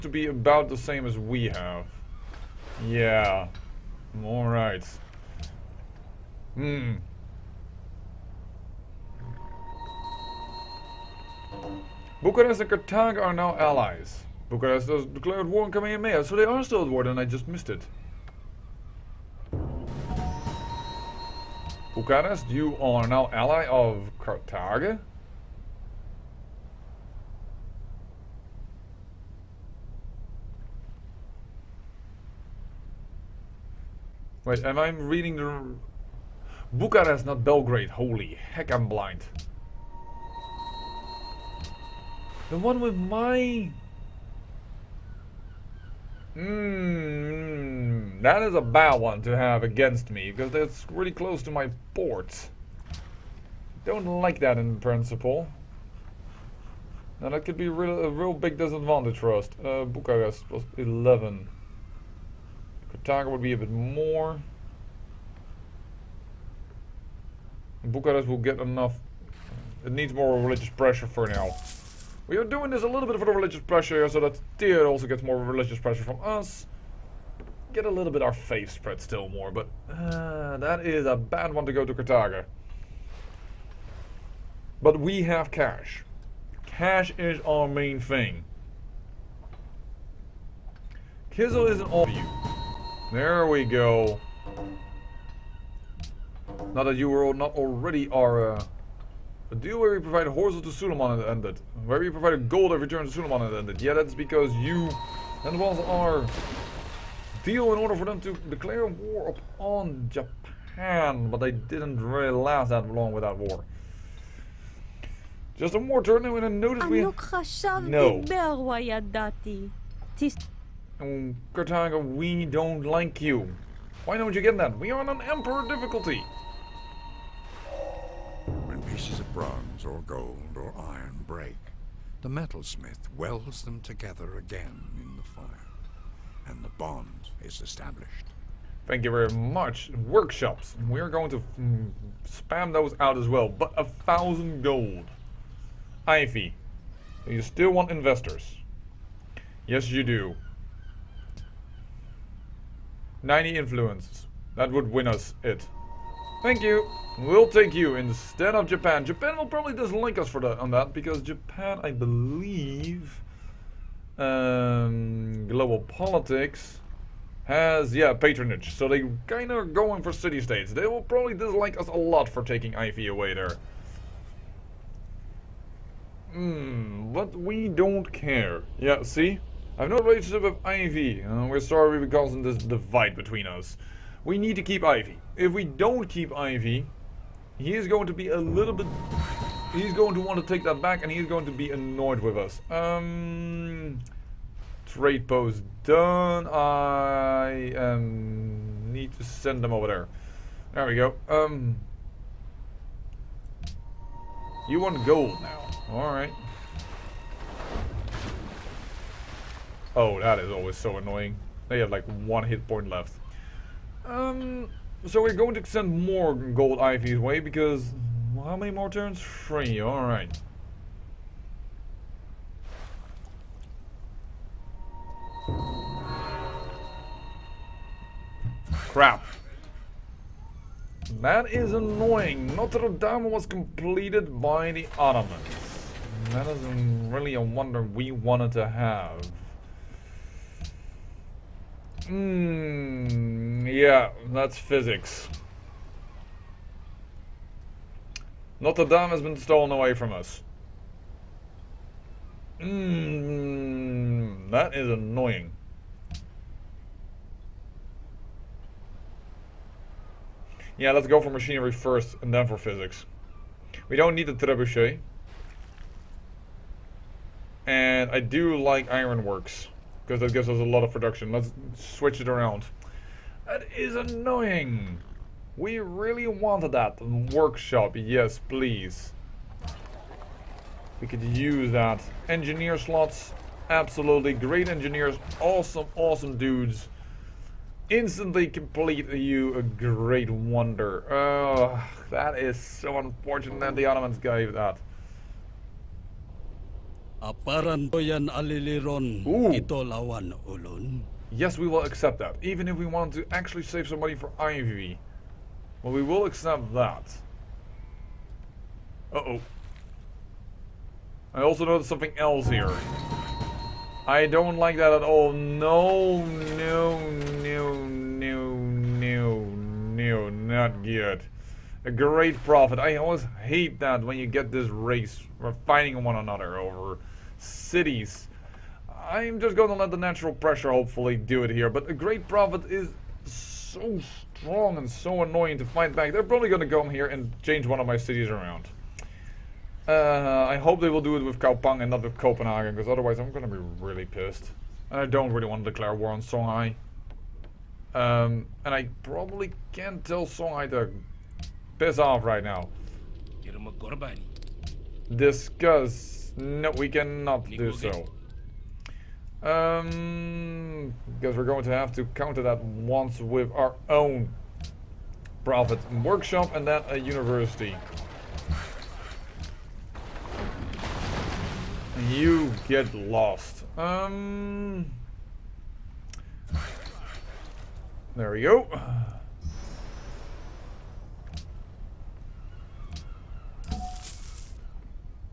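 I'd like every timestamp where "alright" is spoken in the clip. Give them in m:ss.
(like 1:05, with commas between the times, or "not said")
0:04, 3:25, 3:39.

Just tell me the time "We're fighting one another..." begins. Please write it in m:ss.
5:25.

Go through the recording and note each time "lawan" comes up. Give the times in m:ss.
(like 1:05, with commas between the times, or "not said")
4:59.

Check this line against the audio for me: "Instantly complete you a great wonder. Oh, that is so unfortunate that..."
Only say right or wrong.
right.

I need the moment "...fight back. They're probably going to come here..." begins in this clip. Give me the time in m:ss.
5:35.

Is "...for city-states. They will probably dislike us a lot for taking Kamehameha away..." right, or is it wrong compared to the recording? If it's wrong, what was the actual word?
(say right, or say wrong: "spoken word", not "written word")
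wrong: "Ivy", not "Kamehameha".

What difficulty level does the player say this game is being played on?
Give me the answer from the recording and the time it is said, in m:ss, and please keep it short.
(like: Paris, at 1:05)
Emperor, at 2:05.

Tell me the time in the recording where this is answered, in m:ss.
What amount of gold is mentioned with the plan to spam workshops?
2:23.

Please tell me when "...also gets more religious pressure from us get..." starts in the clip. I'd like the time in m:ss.
1:14.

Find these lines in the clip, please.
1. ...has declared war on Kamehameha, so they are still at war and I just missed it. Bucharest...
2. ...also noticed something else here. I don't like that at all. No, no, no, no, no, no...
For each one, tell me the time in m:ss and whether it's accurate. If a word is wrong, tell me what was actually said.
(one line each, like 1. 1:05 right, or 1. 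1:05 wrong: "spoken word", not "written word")
1. 0:14 right
2. 5:11 right.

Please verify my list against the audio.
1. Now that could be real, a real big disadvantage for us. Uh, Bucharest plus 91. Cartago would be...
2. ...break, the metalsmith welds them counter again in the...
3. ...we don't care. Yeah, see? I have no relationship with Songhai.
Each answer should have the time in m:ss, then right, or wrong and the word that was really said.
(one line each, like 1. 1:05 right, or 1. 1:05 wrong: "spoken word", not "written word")
1. 0:57 wrong: "11", not "91"
2. 2:11 wrong: "together", not "counter"
3. 2:57 wrong: "Ivy", not "Songhai".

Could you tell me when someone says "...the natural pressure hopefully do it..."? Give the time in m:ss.
5:29.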